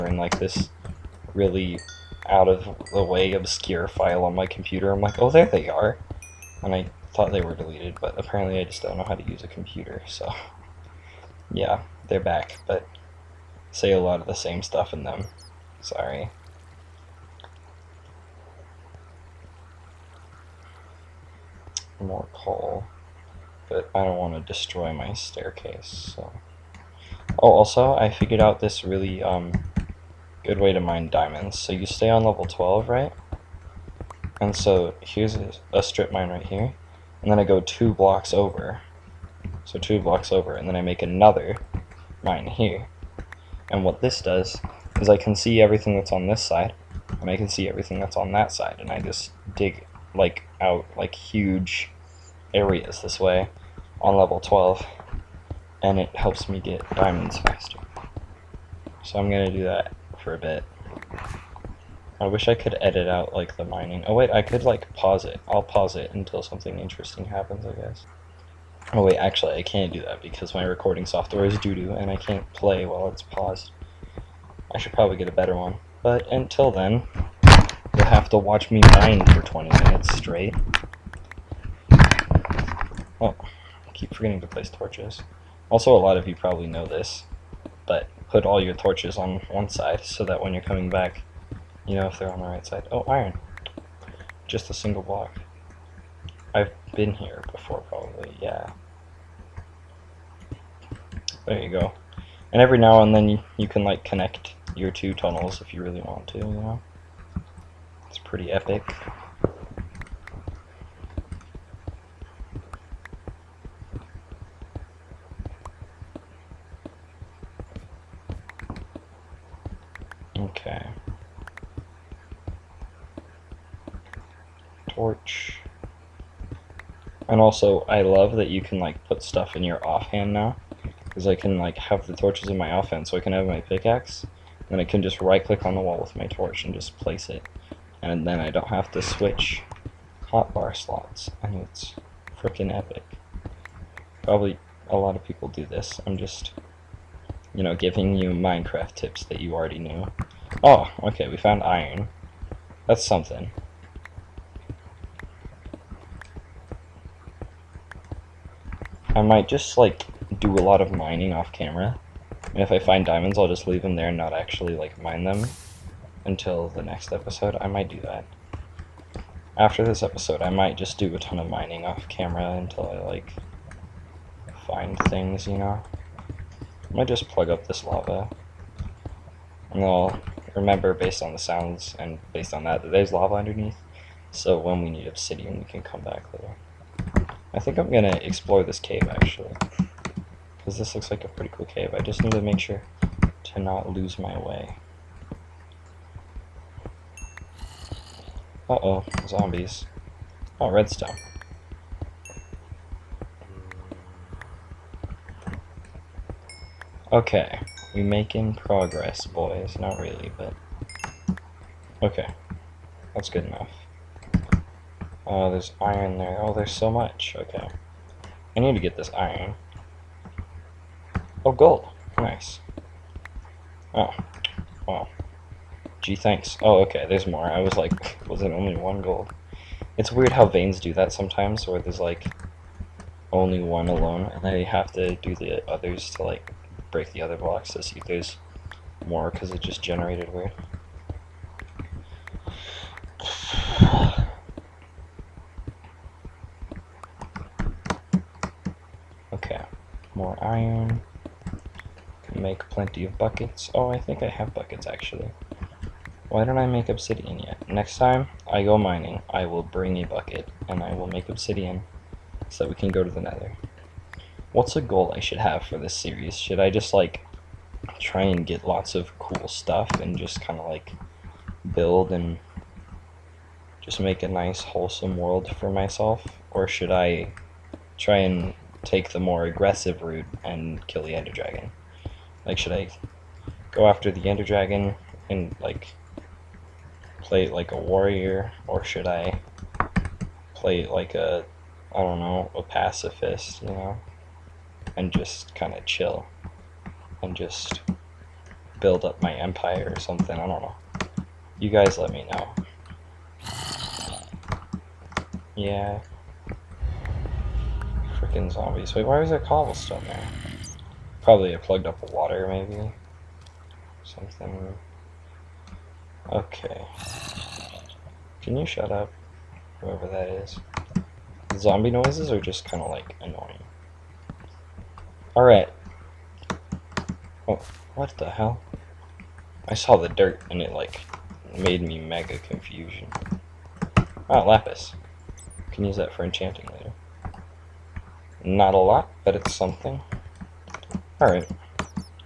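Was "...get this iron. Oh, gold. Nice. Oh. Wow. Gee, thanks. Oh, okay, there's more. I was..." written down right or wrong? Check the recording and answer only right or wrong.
right.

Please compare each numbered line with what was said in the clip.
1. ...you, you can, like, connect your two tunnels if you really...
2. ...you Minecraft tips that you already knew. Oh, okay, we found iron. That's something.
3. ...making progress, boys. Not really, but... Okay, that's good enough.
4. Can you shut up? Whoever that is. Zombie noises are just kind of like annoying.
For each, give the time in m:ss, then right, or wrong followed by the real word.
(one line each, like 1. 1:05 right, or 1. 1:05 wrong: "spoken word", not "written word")
1. 1:43 right
2. 2:28 right
3. 3:28 right
4. 5:18 right.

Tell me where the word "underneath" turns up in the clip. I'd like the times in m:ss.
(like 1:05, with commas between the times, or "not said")
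3:03.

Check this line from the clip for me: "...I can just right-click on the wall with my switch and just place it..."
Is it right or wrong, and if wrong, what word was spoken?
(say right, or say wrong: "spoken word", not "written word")
wrong: "torch", not "switch".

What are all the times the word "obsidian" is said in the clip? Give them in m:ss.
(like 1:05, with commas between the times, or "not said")
3:05, 4:16, 4:21.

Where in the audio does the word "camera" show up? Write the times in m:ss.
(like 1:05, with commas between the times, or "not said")
2:41, 2:52.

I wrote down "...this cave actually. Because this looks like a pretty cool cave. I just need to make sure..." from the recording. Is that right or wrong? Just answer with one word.
right.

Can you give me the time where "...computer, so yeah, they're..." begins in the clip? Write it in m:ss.
0:09.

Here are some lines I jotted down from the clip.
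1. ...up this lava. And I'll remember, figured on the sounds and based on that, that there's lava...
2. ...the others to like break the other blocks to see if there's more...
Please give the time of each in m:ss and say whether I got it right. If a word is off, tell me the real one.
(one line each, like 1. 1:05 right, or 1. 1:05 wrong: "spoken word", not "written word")
1. 2:57 wrong: "based", not "figured"
2. 3:55 right.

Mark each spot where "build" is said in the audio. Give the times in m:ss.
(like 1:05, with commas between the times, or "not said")
4:31, 4:58.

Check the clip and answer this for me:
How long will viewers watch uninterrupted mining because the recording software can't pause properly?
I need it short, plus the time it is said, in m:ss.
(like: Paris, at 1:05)
20 minutes, at 1:19.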